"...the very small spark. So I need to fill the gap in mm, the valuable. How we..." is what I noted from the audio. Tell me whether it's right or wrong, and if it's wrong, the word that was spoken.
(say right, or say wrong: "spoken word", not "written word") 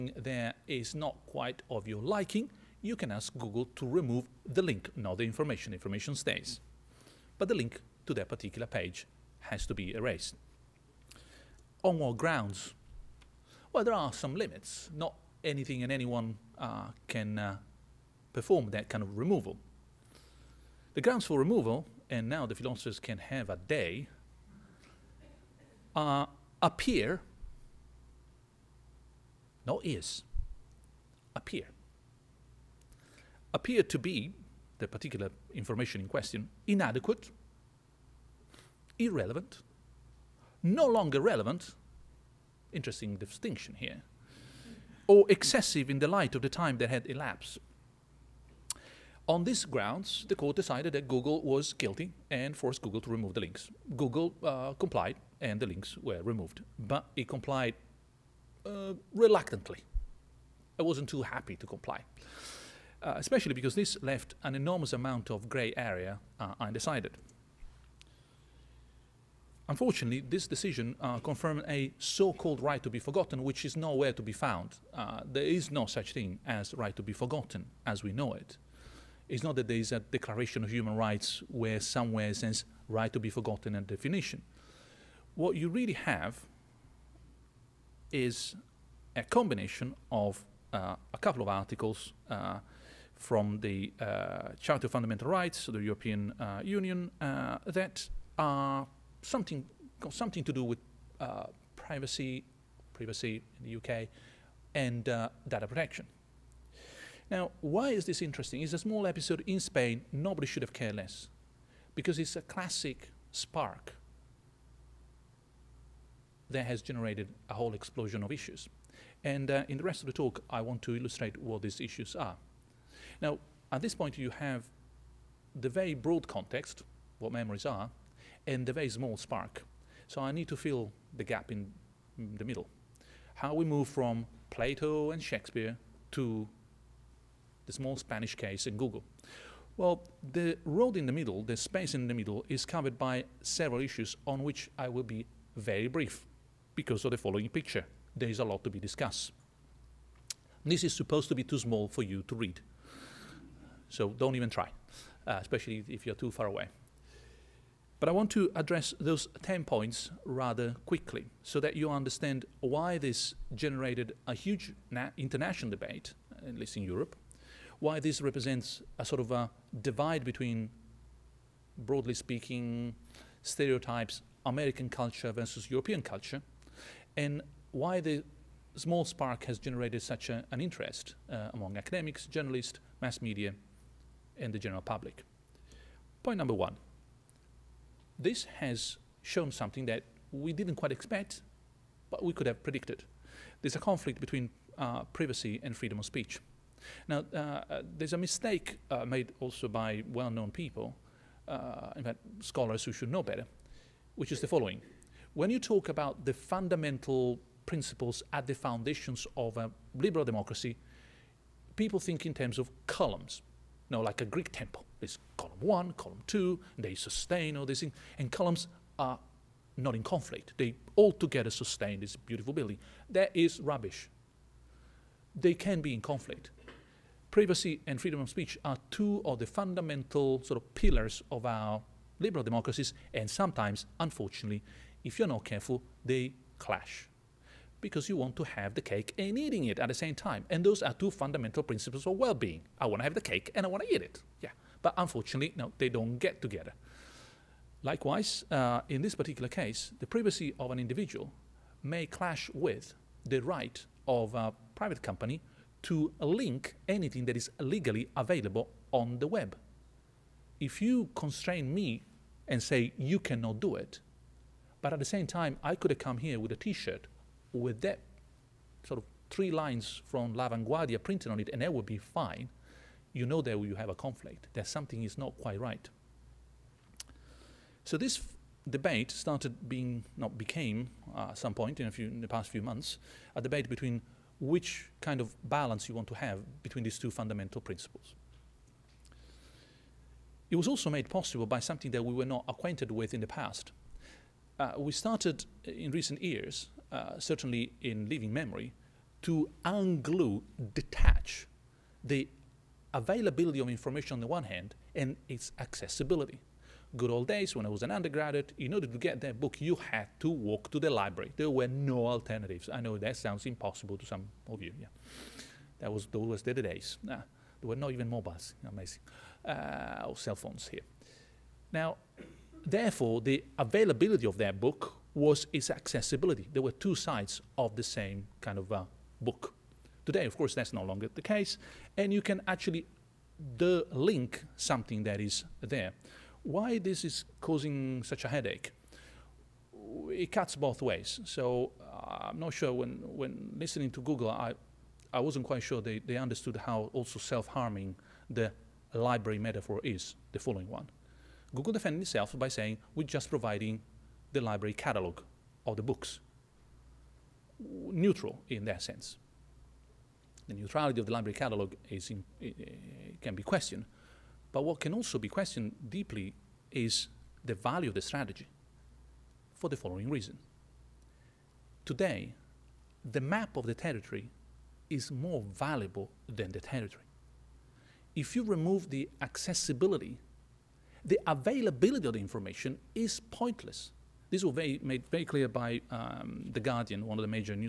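wrong: "middle", not "valuable".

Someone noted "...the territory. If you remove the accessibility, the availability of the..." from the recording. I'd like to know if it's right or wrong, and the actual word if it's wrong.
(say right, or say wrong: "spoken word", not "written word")
right.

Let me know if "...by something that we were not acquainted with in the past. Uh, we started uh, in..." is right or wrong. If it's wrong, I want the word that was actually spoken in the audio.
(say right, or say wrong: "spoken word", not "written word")
right.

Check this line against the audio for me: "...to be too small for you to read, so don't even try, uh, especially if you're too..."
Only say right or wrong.
right.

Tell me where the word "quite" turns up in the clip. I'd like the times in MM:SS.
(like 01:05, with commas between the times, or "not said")
00:01, 03:10, 04:35, 05:45.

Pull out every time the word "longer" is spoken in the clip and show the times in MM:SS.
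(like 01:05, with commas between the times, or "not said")
00:40, 05:30.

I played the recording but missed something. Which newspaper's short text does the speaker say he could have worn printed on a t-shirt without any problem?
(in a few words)
La Vanguardia.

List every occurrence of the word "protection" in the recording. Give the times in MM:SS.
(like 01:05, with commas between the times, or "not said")
01:45.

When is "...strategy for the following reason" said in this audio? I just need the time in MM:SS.
06:08.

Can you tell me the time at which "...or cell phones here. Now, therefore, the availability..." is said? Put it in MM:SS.
05:20.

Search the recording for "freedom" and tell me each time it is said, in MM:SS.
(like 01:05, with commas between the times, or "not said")
03:15, 03:48.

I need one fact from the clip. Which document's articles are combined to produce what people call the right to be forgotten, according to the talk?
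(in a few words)
Charter of Fundamental Rights.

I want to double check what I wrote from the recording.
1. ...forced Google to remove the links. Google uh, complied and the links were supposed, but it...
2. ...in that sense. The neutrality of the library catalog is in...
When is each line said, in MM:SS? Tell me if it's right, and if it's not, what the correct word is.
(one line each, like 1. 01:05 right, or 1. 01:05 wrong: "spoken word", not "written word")
1. 00:52 wrong: "removed", not "supposed"
2. 05:58 right.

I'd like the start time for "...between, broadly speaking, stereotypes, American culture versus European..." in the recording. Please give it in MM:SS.
02:50.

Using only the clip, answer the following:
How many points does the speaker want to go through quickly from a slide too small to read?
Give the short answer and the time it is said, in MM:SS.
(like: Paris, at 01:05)
10, at 02:39.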